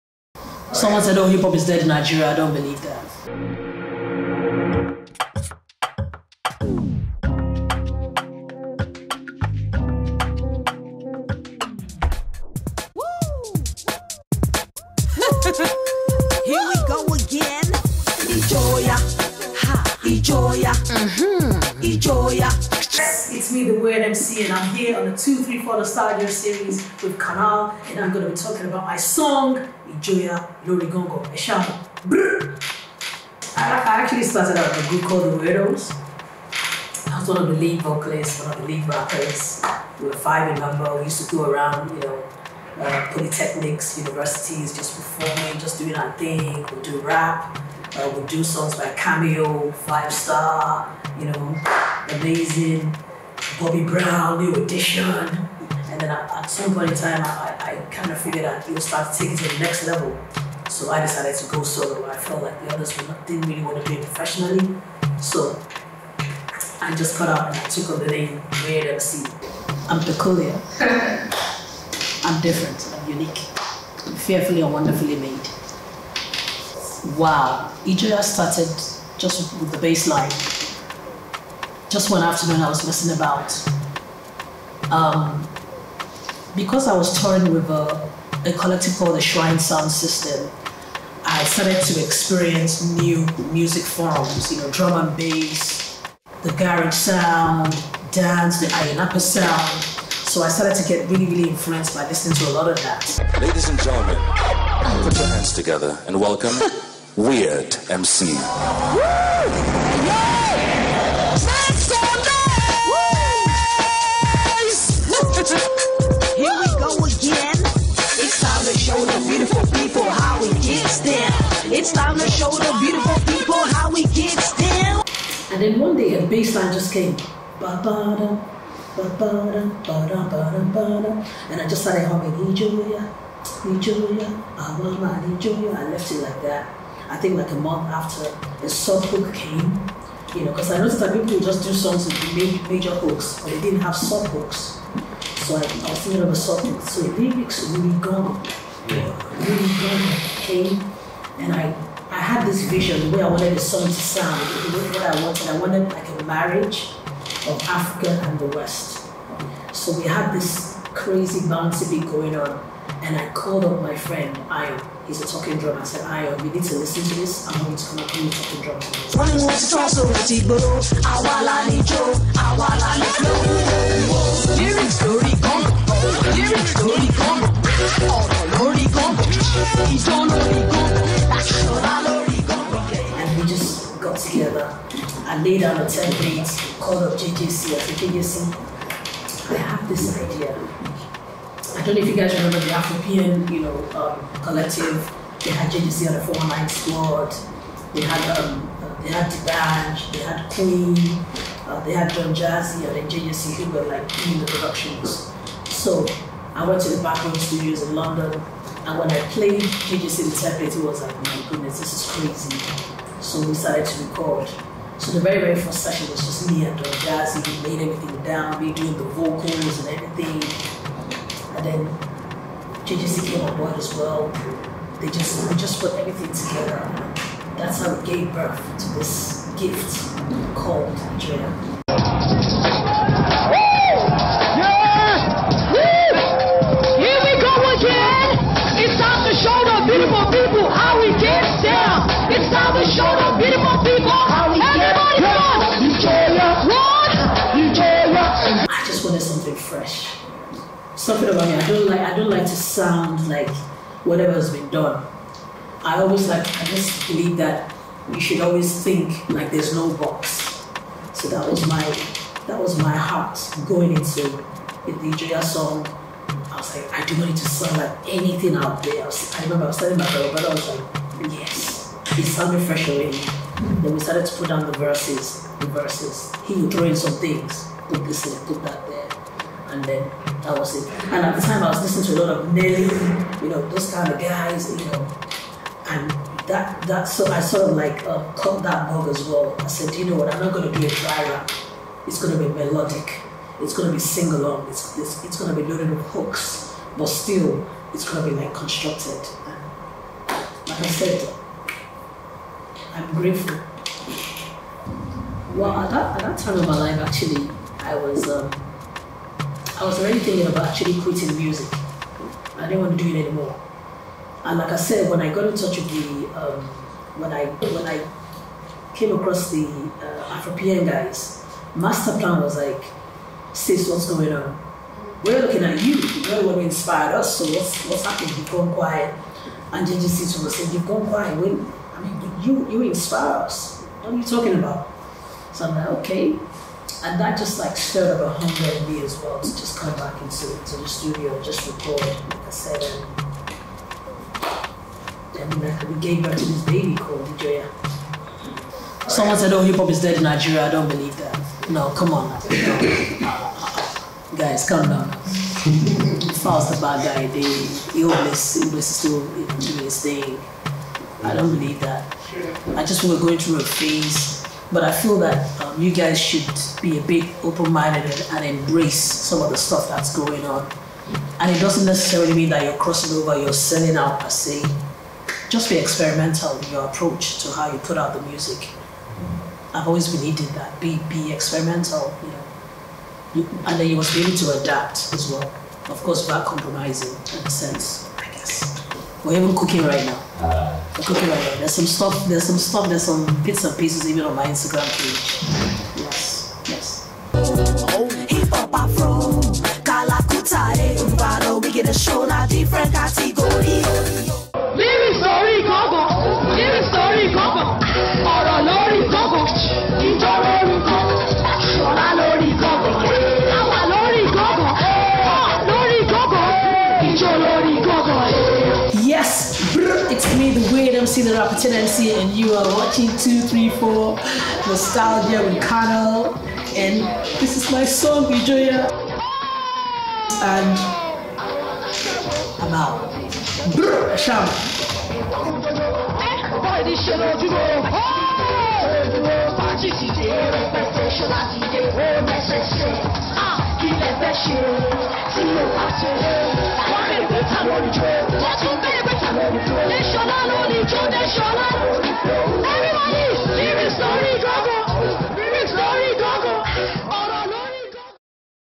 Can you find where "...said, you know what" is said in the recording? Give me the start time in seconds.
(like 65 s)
289 s.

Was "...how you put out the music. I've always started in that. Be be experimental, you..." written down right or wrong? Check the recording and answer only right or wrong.
wrong.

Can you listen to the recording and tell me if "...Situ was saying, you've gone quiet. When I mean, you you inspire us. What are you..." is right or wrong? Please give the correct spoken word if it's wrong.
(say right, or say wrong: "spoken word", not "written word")
right.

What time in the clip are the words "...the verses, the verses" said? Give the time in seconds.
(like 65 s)
274 s.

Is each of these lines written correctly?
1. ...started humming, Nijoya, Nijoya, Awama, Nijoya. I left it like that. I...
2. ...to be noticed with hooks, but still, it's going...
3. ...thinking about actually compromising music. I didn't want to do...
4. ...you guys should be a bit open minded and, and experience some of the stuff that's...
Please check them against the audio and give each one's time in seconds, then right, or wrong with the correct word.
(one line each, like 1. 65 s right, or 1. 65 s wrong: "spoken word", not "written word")
1. 131 s right
2. 295 s wrong: "loaded", not "noticed"
3. 310 s wrong: "quitting", not "compromising"
4. 365 s wrong: "embrace", not "experience".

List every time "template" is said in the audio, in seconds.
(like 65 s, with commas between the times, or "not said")
185 s, 210 s.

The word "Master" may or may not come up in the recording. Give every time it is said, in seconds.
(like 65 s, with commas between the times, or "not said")
321 s.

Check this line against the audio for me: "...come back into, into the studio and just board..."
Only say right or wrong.
wrong.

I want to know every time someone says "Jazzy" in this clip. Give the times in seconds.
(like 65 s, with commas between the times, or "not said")
202 s, 216 s.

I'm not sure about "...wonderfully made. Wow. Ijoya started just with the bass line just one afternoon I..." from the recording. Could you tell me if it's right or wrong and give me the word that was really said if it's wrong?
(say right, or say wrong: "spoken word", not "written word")
right.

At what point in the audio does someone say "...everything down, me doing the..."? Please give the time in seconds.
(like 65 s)
217 s.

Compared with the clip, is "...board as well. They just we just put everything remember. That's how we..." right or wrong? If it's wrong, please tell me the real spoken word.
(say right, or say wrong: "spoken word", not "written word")
wrong: "together", not "remember".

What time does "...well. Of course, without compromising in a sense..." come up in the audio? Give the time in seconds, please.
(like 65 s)
385 s.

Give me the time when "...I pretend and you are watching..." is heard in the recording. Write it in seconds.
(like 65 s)
421 s.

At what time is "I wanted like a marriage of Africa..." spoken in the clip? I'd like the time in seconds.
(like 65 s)
155 s.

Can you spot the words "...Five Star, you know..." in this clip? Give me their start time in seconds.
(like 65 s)
49 s.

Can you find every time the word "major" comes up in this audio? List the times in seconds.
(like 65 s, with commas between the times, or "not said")
142 s.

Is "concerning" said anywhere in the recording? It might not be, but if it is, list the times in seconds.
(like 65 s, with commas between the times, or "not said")
not said.